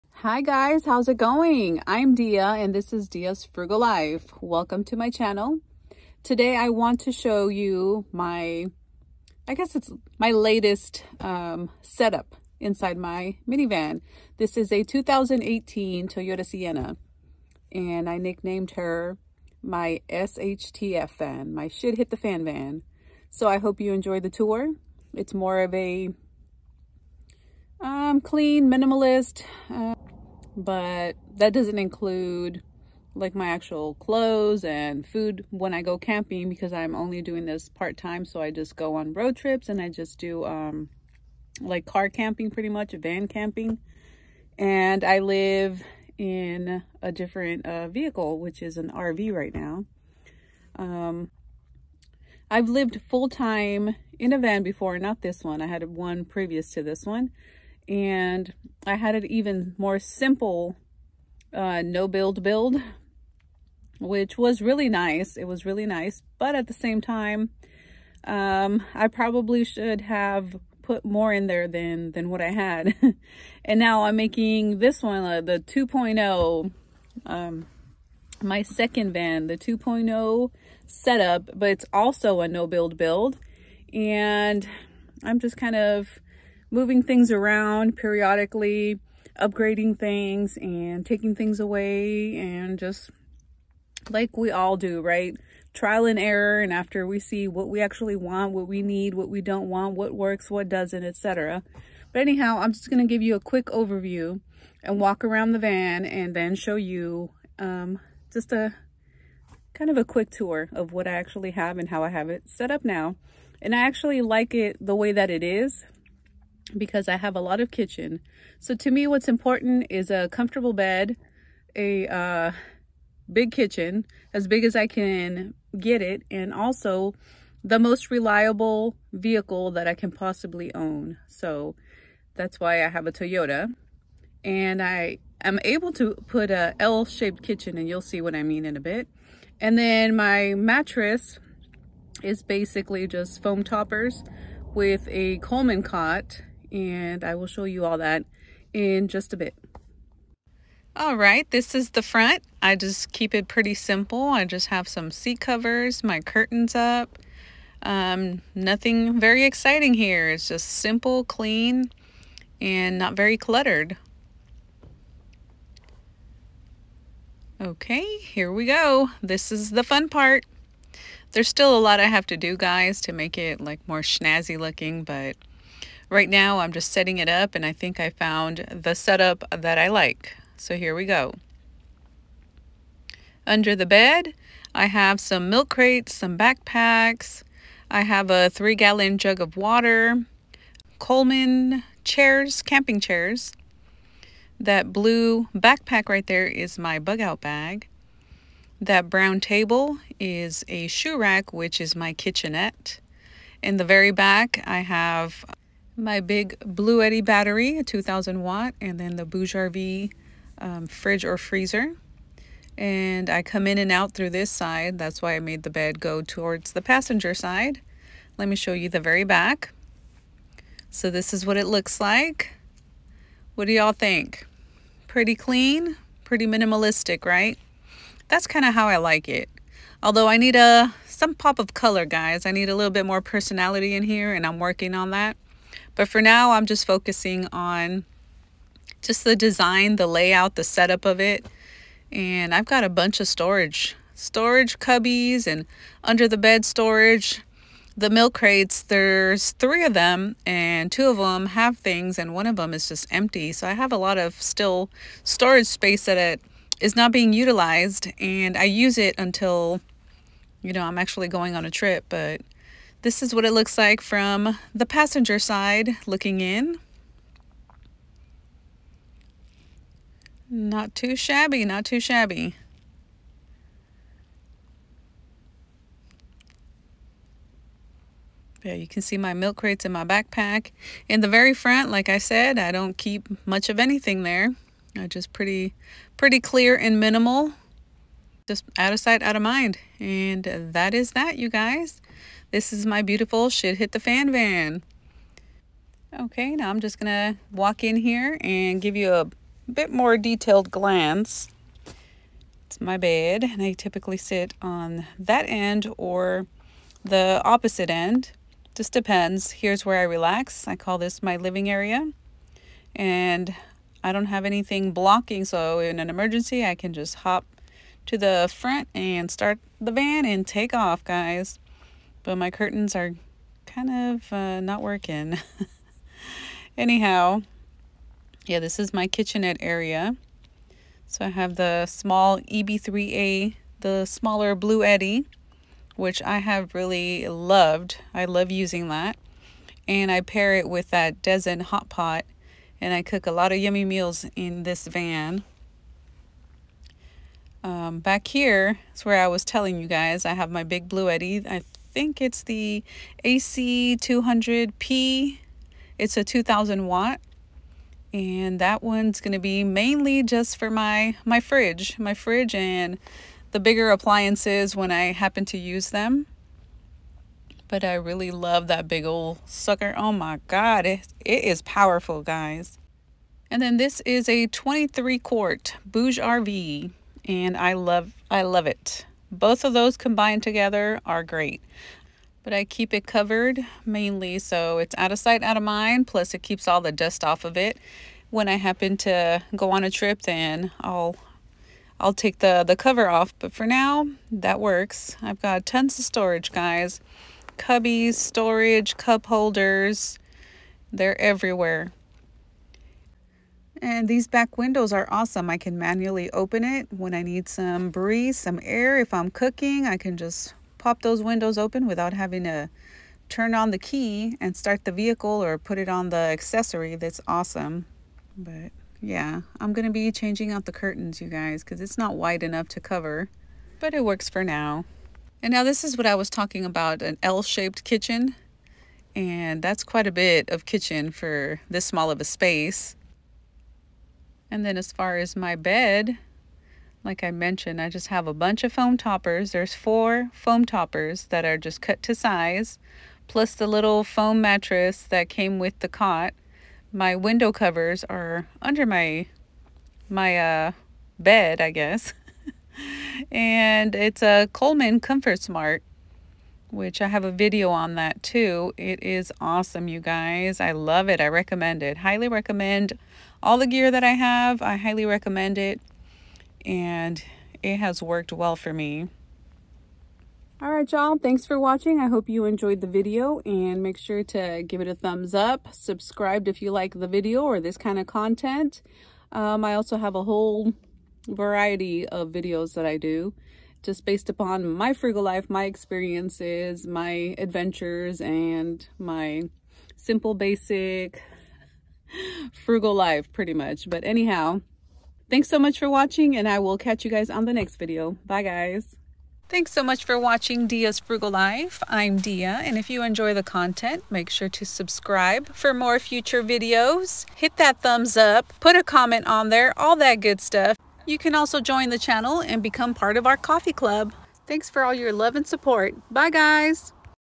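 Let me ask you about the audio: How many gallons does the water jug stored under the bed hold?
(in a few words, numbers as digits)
3.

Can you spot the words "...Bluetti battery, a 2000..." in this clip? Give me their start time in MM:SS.
03:26.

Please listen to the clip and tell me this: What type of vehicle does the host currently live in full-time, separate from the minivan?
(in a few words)
RV.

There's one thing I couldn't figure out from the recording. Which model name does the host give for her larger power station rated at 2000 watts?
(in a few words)
AC200P.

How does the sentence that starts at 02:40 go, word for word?
It's just simple, clean, and not very cluttered.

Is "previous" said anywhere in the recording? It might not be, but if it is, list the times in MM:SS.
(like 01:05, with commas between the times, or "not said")
00:56.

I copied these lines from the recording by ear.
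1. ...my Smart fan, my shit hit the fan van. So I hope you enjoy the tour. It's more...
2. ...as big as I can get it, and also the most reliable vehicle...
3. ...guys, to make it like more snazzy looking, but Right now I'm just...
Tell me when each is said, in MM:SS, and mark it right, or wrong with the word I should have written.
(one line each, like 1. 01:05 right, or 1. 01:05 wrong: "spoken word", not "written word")
1. 00:19 wrong: "SHTF", not "Smart"
2. 02:04 right
3. 02:52 right.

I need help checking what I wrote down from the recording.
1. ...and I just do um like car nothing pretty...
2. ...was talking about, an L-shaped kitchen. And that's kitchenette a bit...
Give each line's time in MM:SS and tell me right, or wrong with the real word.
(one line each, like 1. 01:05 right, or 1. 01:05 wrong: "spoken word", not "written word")
1. 00:39 wrong: "camping", not "nothing"
2. 07:06 wrong: "quite", not "kitchenette".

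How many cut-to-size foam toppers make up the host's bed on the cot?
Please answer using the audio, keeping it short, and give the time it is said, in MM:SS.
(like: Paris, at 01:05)
4, at 07:19.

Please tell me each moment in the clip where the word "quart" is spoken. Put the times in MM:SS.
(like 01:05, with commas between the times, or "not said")
06:15.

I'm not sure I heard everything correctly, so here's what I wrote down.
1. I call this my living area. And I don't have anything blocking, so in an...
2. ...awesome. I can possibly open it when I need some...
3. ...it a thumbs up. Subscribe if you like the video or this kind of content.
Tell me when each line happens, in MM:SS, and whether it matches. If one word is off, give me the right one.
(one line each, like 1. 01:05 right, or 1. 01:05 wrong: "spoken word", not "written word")
1. 05:10 right
2. 06:45 wrong: "manually", not "possibly"
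3. 07:54 right.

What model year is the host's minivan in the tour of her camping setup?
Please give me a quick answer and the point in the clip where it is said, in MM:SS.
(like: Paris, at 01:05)
2018, at 00:14.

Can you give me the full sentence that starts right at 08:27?
Hit that thumbs up, put a comment on there, all that good stuff.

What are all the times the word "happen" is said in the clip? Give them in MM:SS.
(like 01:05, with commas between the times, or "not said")
06:05, 06:28.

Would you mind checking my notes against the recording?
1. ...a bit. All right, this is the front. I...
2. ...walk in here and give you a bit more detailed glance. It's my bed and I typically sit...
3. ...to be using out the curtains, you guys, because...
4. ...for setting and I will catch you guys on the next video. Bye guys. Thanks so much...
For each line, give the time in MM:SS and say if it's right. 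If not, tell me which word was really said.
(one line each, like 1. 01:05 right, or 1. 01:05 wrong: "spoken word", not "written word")
1. 02:29 right
2. 04:57 right
3. 06:59 wrong: "changing", not "using"
4. 08:15 wrong: "watching", not "setting".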